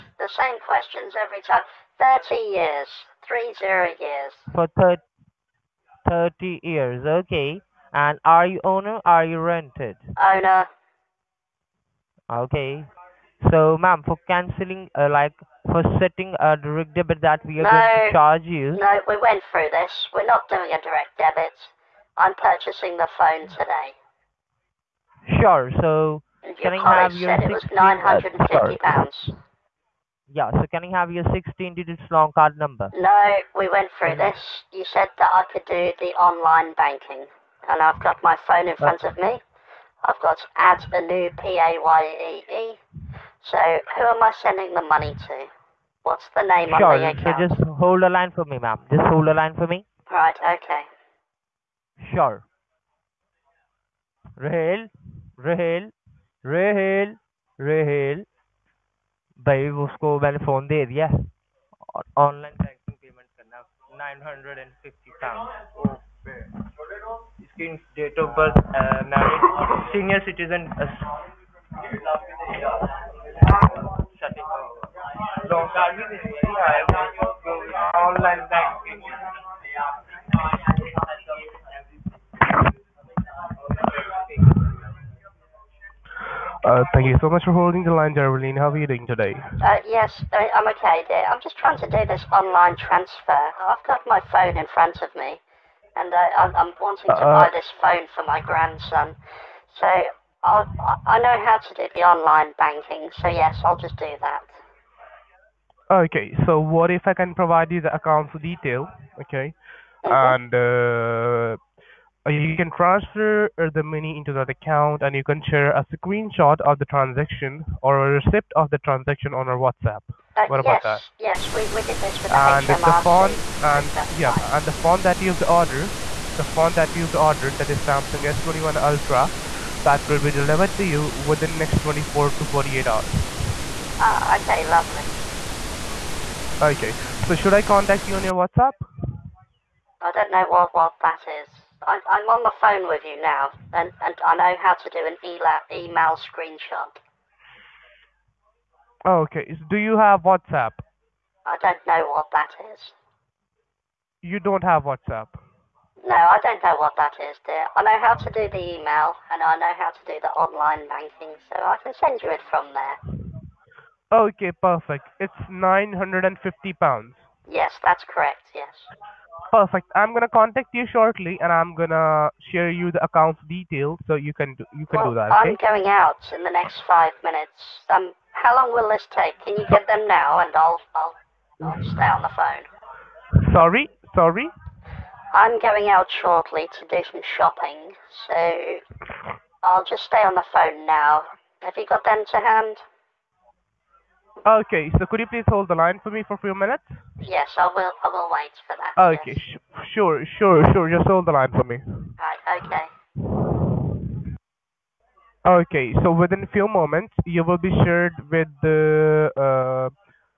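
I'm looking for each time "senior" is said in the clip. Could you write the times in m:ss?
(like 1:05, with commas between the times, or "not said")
1:09.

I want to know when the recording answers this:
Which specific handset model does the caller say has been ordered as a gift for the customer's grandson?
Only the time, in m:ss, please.
2:07.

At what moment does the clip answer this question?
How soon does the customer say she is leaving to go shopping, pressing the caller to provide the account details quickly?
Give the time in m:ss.
2:56.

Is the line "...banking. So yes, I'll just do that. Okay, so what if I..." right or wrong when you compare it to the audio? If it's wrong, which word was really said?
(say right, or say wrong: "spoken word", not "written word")
right.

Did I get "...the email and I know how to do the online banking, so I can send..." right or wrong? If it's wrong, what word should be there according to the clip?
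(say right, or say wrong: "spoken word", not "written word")
right.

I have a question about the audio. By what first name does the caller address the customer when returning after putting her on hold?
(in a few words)
Darlene.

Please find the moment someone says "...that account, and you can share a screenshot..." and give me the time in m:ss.
1:54.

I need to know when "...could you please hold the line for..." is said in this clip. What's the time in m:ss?
3:15.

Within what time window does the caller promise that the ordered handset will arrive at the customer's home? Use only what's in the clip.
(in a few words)
24 to 48 hours.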